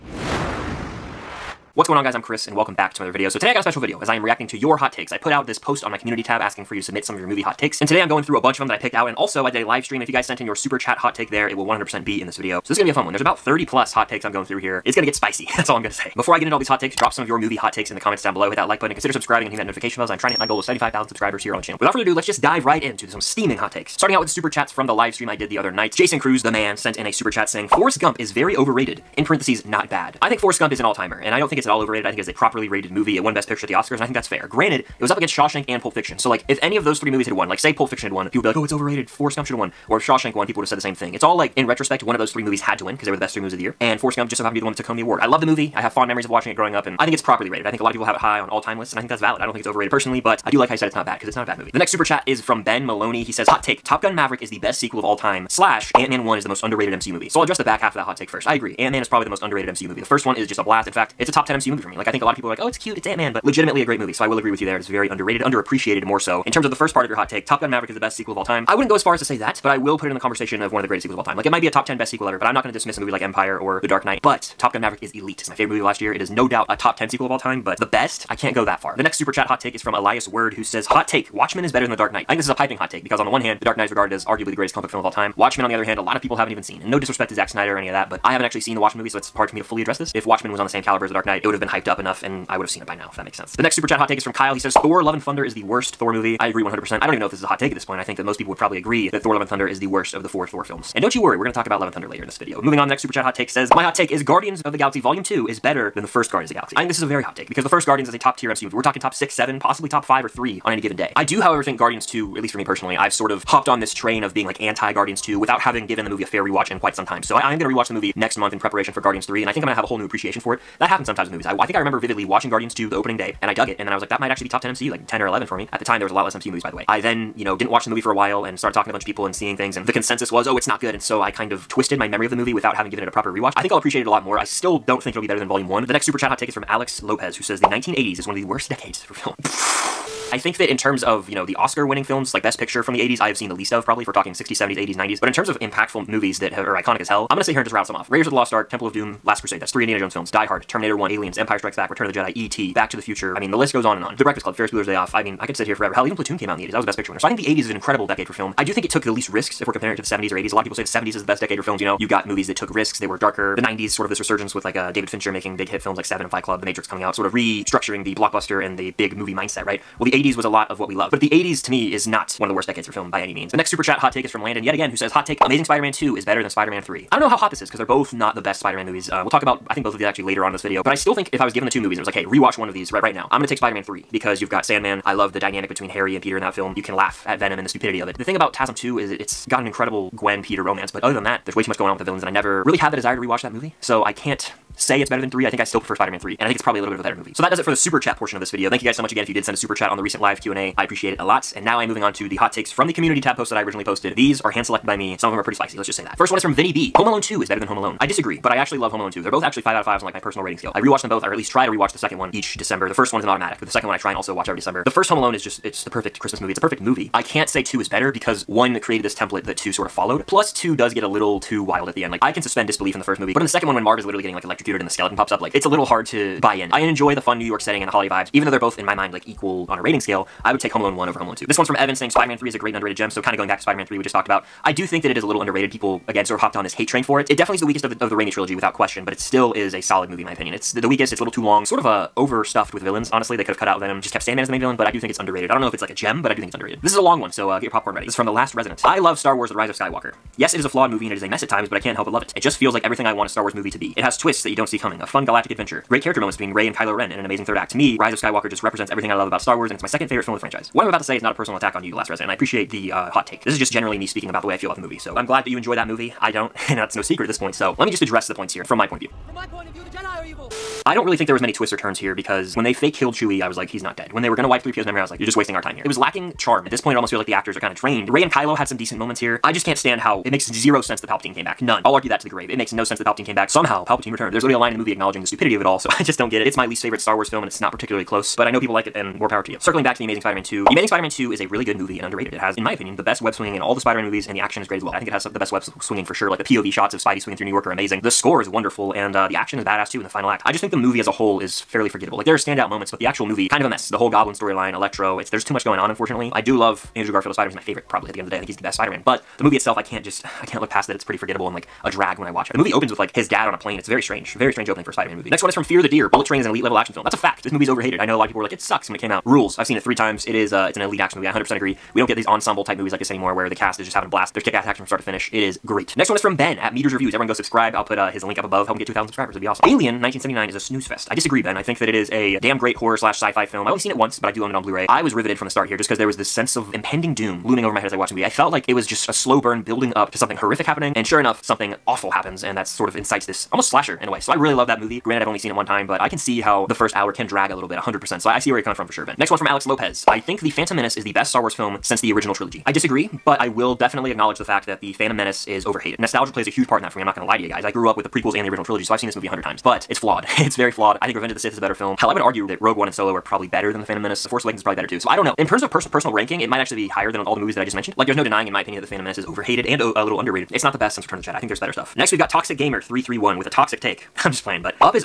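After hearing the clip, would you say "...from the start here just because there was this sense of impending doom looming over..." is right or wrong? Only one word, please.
right.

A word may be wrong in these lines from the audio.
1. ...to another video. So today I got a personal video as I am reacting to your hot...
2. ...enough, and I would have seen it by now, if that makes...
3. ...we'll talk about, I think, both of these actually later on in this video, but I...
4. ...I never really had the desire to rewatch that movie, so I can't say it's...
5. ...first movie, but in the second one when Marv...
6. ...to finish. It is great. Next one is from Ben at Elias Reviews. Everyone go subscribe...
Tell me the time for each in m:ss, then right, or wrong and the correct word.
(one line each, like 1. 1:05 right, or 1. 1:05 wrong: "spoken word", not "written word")
1. 0:02 wrong: "special", not "personal"
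2. 1:31 right
3. 2:59 right
4. 3:12 right
5. 3:43 right
6. 5:24 wrong: "Meters", not "Elias".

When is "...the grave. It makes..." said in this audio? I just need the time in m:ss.
4:42.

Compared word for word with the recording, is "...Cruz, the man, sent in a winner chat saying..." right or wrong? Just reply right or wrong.
wrong.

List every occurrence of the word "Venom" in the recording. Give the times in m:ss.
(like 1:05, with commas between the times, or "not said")
3:07, 4:03.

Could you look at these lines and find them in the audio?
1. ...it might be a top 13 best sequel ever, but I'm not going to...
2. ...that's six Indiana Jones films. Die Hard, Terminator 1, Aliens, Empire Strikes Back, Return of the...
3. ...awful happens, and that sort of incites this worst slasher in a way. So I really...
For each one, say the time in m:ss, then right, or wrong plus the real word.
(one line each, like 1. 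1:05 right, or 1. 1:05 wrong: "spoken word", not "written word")
1. 1:11 wrong: "10", not "13"
2. 2:29 wrong: "three", not "six"
3. 5:41 wrong: "almost", not "worst".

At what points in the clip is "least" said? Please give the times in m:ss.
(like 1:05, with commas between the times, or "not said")
1:52, 2:23, 2:39, 3:31, 4:46.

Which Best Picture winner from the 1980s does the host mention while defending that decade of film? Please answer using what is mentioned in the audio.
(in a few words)
Platoon.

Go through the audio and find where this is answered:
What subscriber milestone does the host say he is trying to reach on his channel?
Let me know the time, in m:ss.
0:20.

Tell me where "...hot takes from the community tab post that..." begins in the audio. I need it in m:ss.
3:22.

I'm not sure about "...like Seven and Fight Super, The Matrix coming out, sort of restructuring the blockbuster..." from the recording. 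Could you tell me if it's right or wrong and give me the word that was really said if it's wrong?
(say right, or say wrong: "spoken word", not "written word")
wrong: "Club", not "Super".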